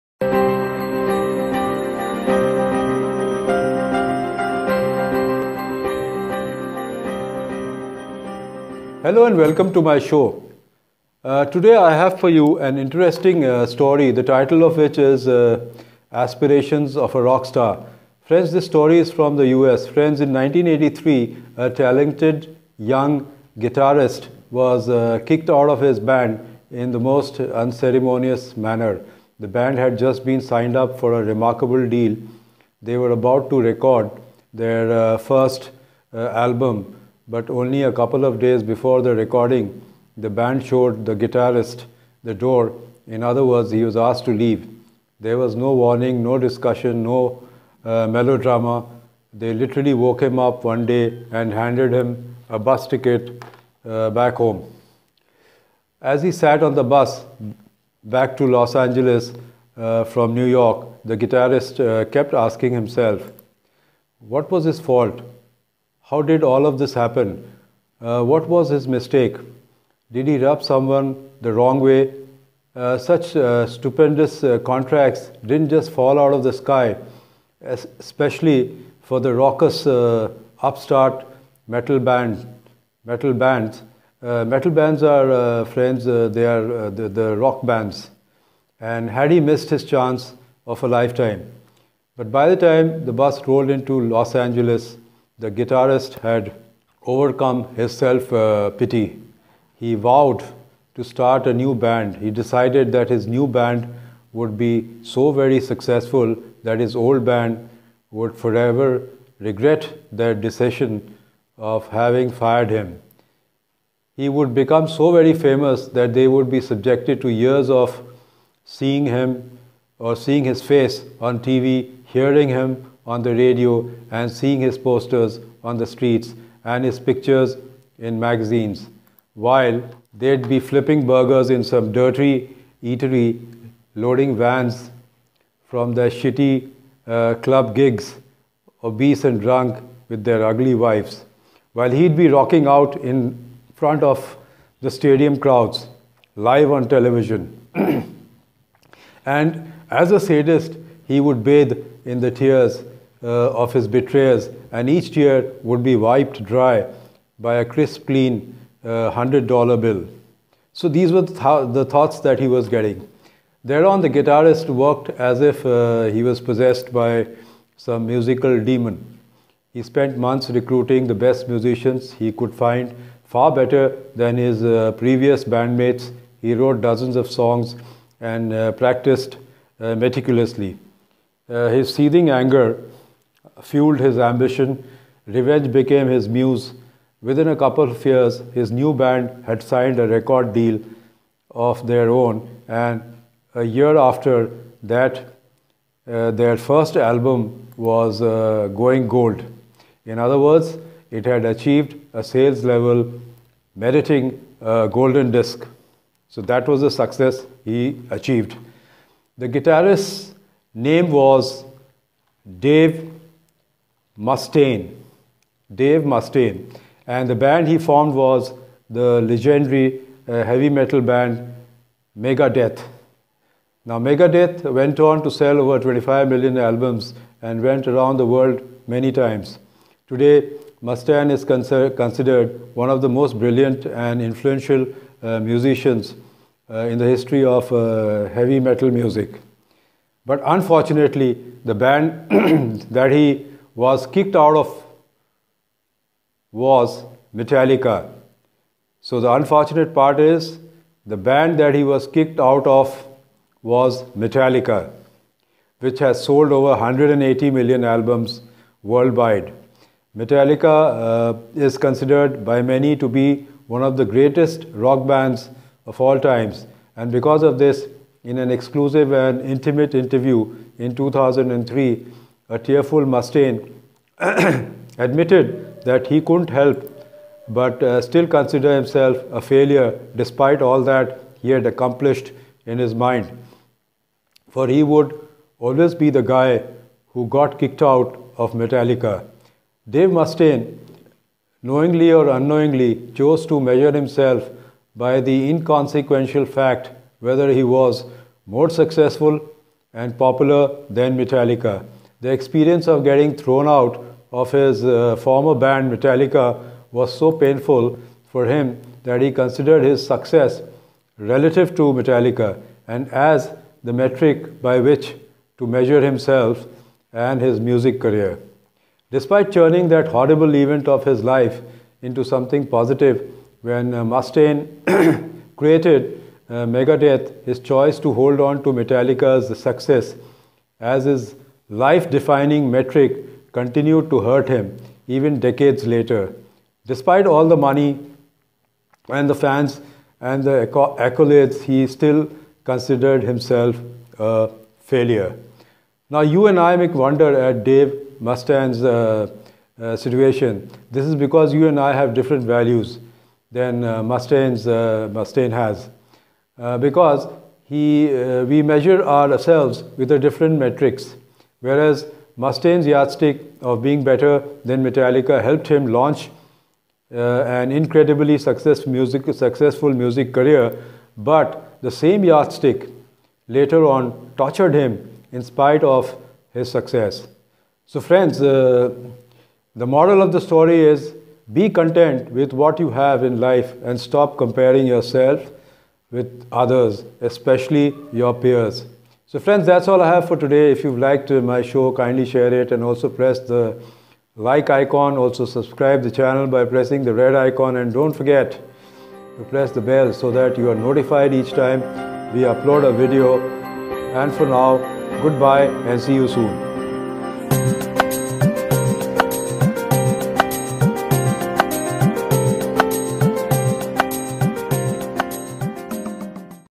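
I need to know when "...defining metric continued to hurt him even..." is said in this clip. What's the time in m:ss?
5:32.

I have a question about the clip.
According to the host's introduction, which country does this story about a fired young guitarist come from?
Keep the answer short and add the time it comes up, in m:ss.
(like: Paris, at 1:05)
US, at 0:19.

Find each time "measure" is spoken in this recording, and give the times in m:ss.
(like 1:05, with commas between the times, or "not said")
4:53, 5:15, 5:58.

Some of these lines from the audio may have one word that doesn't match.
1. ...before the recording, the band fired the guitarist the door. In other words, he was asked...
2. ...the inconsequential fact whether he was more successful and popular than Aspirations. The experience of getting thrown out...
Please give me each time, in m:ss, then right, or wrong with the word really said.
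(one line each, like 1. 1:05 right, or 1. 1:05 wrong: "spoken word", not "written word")
1. 0:38 wrong: "showed", not "fired"
2. 4:55 wrong: "Metallica", not "Aspirations".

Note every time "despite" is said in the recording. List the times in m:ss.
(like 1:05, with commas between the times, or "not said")
4:40, 5:19, 5:36.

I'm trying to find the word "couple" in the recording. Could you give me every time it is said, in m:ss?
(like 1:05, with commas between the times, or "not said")
0:37, 3:07.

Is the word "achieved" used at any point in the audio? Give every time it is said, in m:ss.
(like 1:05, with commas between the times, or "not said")
3:21, 3:28.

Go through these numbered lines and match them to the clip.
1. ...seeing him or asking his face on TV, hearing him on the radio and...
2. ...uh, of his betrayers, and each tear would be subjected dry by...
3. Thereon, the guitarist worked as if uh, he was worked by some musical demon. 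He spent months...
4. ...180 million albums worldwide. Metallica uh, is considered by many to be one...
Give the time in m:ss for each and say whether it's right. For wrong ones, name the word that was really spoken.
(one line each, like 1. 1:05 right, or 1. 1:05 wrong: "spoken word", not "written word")
1. 1:58 wrong: "seeing", not "asking"
2. 2:33 wrong: "wiped", not "subjected"
3. 2:43 wrong: "possessed", not "worked"
4. 4:16 right.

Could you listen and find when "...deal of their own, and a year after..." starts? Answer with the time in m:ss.
3:10.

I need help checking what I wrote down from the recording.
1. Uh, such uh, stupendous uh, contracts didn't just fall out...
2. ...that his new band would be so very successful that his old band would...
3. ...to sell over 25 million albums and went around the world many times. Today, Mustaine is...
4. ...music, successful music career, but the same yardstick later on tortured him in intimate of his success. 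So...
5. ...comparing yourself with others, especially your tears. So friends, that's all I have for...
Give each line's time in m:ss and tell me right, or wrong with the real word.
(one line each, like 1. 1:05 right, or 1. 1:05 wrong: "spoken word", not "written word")
1. 1:12 right
2. 1:42 right
3. 3:45 right
4. 6:08 wrong: "spite", not "intimate"
5. 6:24 wrong: "peers", not "tears".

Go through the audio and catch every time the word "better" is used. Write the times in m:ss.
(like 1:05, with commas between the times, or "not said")
2:53, 6:04.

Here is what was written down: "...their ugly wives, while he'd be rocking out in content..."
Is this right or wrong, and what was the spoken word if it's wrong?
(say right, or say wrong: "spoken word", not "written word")
wrong: "front", not "content".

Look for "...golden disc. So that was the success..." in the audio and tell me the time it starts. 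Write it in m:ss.
3:24.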